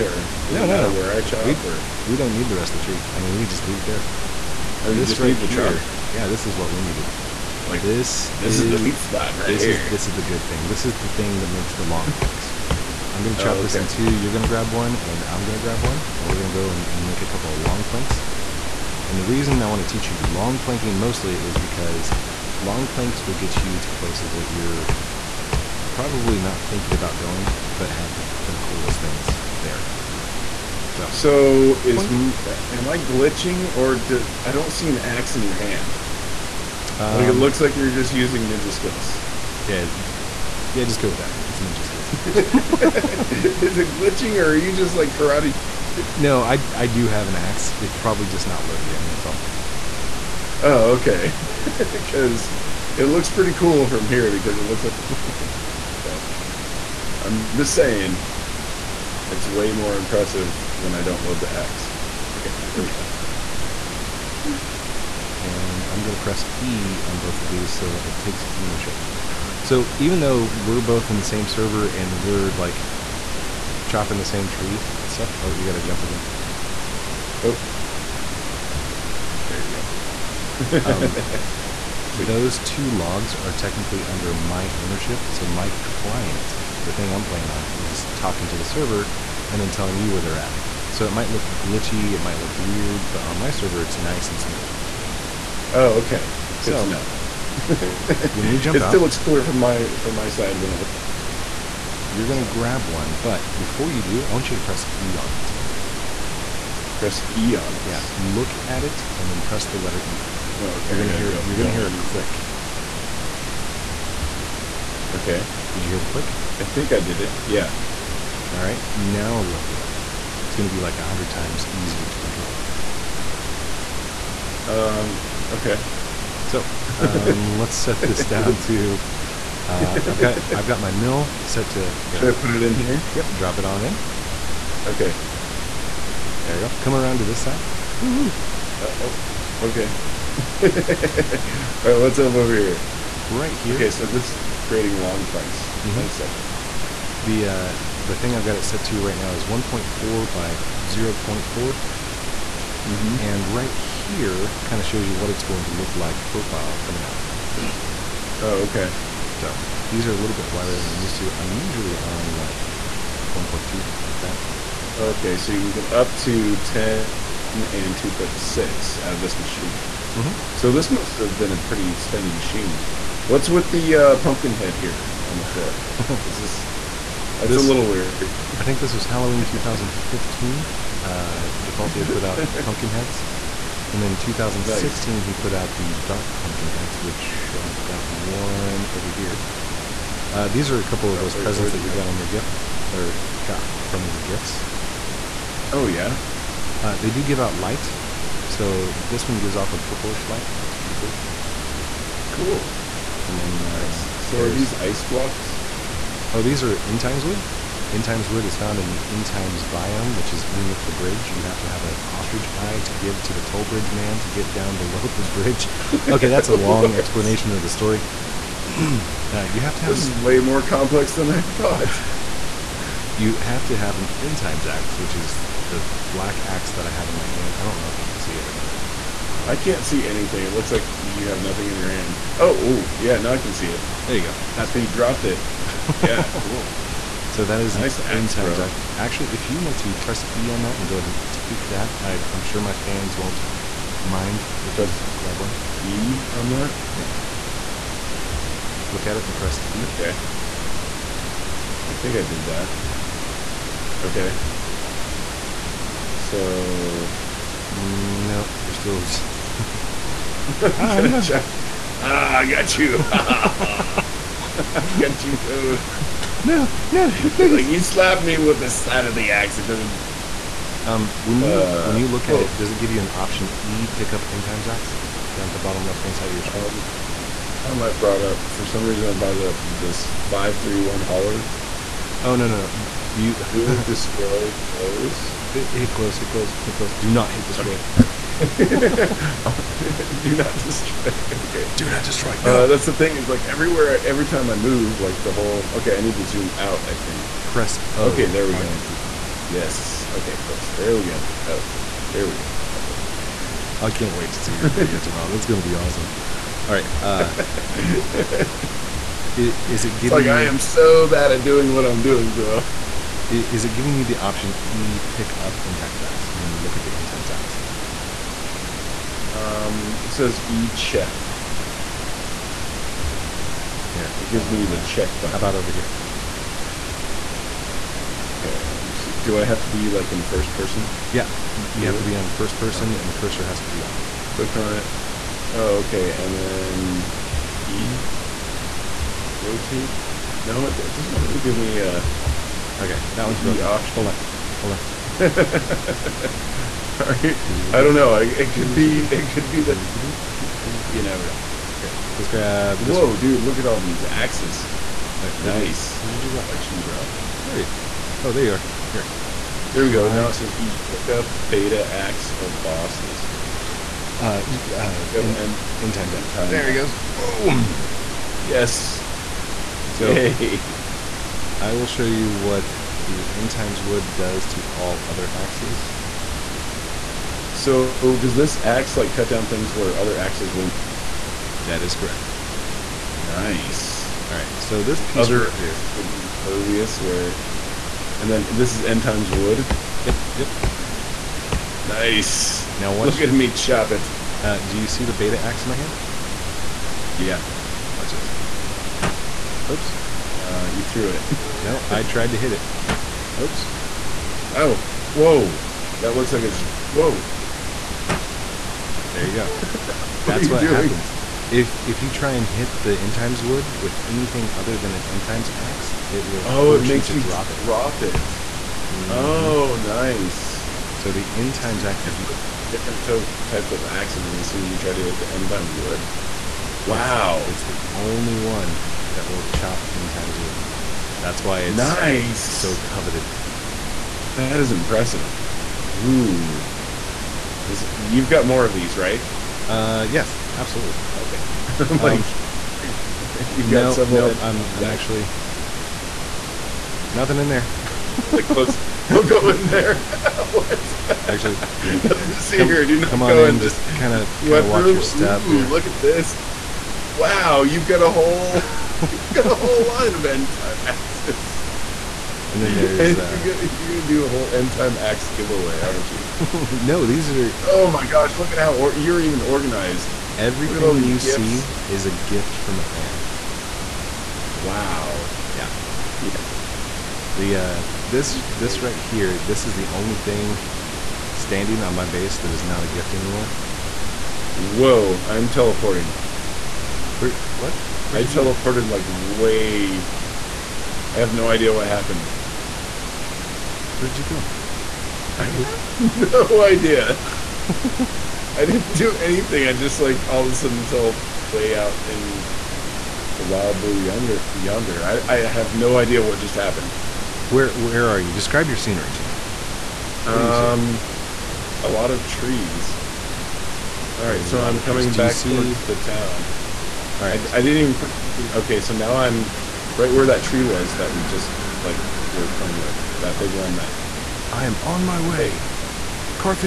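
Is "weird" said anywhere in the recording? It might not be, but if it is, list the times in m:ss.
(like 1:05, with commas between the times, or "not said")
1:32, 2:57.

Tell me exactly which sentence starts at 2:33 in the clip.
And right here kind of shows you what it's going to look like profile coming out.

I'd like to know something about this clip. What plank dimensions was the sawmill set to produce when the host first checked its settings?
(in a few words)
1.4 by 0.4.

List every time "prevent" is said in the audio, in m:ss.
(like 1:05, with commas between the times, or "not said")
not said.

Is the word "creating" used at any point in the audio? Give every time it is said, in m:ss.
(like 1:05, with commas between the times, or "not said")
2:24.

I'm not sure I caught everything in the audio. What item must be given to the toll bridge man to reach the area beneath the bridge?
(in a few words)
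Ostrich eye.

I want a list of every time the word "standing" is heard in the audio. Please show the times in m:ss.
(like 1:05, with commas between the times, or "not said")
8:01.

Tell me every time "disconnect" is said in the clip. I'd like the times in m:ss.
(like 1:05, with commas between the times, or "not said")
not said.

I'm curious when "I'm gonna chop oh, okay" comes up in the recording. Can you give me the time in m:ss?
0:13.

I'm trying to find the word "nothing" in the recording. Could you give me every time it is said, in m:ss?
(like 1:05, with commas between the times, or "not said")
3:51, 7:27.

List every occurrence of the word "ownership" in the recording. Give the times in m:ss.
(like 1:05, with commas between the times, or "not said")
1:08, 1:24.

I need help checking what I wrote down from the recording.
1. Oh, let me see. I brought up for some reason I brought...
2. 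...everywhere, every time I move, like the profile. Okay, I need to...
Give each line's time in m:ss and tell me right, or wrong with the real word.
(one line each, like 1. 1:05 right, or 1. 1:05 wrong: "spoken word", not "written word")
1. 4:36 right
2. 4:53 wrong: "whole", not "profile".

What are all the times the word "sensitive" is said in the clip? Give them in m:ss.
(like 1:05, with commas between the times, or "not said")
not said.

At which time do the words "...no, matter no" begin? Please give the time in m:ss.
0:00.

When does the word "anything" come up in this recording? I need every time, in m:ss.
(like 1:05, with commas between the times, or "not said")
3:50, 6:54, 8:19, 8:38.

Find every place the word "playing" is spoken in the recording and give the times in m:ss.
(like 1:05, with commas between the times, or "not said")
1:27, 8:42.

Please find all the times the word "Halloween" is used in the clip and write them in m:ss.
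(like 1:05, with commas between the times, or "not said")
2:59.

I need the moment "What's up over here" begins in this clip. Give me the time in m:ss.
2:21.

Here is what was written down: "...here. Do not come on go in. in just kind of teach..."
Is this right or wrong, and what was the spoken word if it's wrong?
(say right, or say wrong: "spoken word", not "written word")
wrong: "watch", not "teach".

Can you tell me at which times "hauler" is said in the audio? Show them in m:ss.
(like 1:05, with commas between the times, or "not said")
4:41.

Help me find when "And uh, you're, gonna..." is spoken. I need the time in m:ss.
7:43.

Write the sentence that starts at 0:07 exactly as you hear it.
Like this, this is, is the sweet spot right this here.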